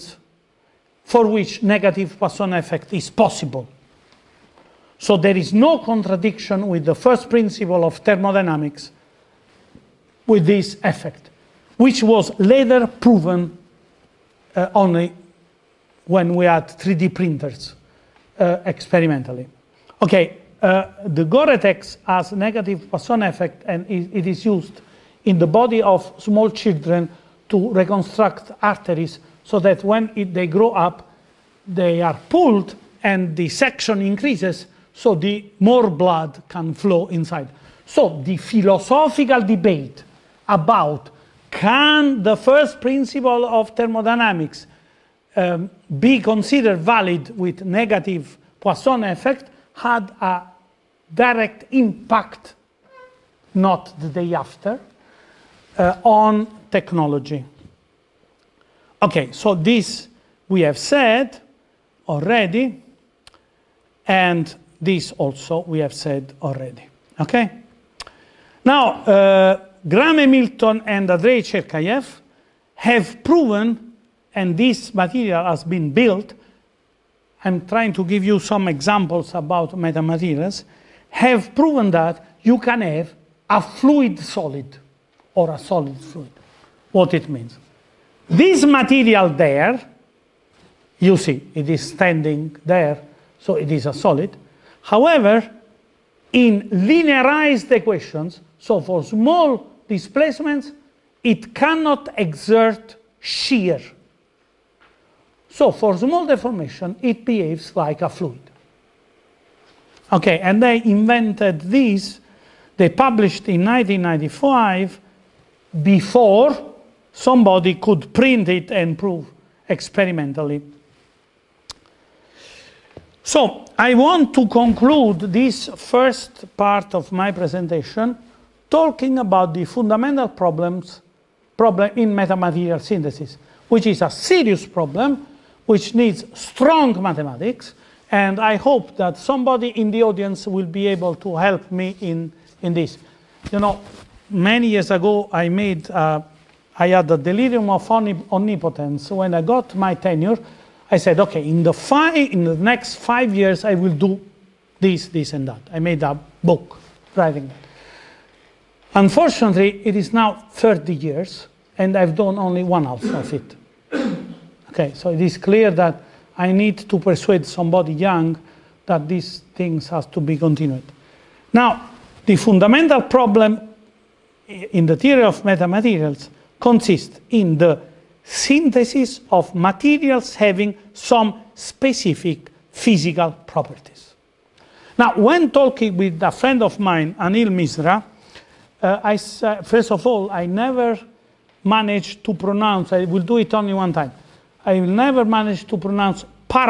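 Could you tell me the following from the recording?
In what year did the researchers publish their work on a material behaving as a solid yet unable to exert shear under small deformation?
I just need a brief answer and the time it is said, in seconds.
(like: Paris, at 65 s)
1995, at 113 s.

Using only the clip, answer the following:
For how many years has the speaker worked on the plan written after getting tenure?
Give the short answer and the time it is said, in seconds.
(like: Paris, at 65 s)
30, at 160 s.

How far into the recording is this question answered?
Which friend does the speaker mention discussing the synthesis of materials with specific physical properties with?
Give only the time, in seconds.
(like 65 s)
187 s.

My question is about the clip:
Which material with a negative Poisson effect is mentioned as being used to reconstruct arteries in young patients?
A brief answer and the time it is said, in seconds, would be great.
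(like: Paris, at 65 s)
Gore-Tex, at 21 s.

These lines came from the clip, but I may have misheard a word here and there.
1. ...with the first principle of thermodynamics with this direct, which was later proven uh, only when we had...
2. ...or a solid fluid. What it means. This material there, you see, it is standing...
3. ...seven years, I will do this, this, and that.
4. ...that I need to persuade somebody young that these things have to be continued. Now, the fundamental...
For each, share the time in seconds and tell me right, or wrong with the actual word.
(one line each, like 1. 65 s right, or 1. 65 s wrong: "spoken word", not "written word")
1. 6 s wrong: "effect", not "direct"
2. 85 s right
3. 152 s wrong: "five", not "seven"
4. 165 s right.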